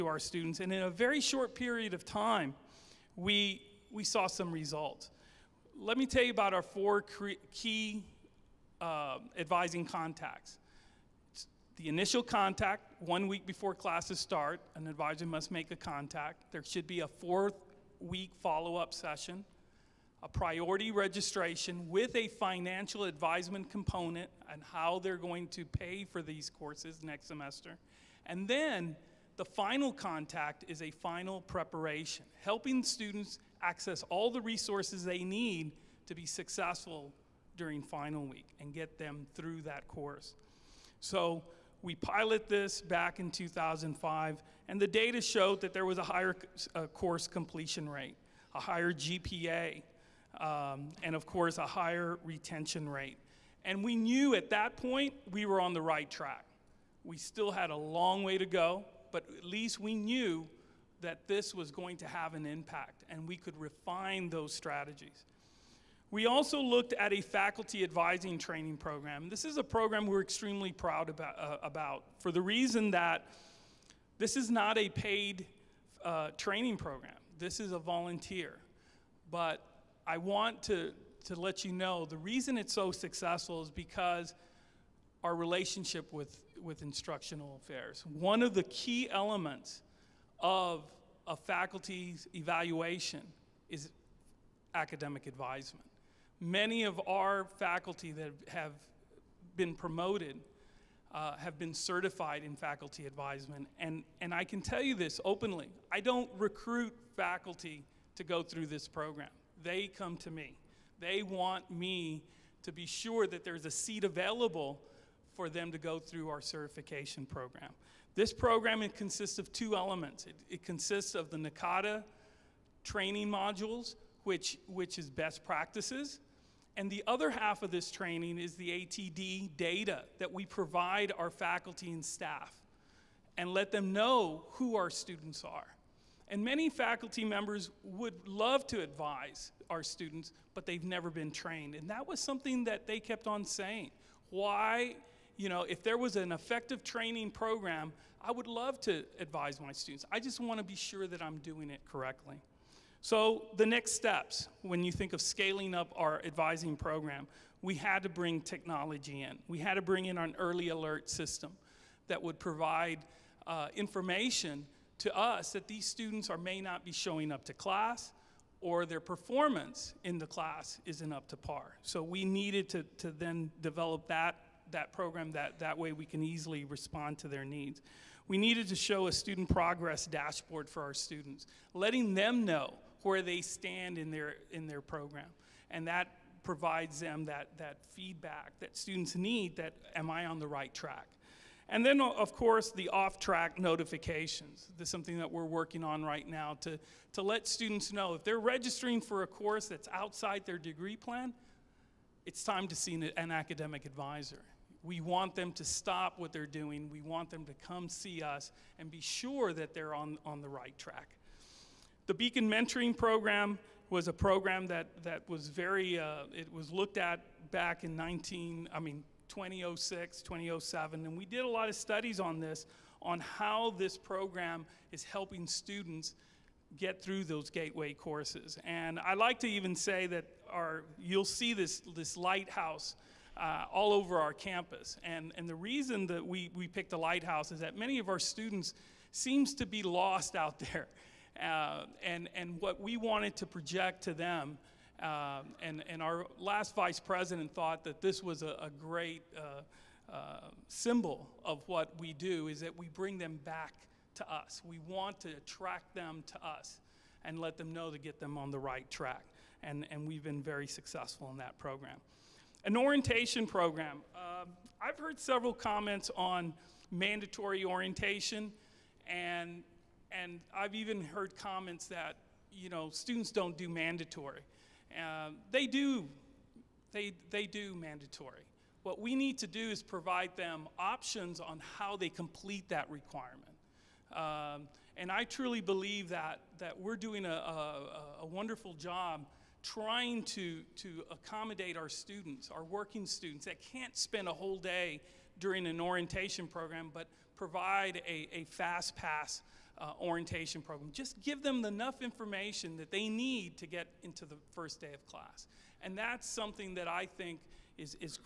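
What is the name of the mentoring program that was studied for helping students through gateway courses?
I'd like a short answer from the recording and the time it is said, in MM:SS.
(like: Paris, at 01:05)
Beacon Mentoring Program, at 03:32.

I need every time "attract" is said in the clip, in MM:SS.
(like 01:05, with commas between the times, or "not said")
04:15.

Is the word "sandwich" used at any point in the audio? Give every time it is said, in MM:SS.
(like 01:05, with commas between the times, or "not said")
not said.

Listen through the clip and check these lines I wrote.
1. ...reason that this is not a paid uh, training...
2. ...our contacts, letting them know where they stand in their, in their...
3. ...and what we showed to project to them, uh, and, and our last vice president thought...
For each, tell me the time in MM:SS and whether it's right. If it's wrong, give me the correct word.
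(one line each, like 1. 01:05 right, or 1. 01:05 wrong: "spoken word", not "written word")
1. 01:12 right
2. 03:00 wrong: "students", not "contacts"
3. 04:02 wrong: "wanted", not "showed".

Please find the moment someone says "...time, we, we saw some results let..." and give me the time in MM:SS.
00:02.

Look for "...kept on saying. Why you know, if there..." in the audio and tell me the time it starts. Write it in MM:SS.
02:22.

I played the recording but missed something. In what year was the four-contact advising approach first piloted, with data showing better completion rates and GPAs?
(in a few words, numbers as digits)
2005.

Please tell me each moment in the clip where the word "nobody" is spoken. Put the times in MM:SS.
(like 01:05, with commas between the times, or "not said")
not said.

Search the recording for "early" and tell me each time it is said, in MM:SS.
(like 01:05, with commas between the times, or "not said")
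02:40.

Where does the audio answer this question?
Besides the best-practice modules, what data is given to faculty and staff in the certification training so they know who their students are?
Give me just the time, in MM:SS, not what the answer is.
02:08.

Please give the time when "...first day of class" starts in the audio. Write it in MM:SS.
05:04.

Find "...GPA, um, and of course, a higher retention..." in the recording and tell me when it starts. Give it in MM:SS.
00:48.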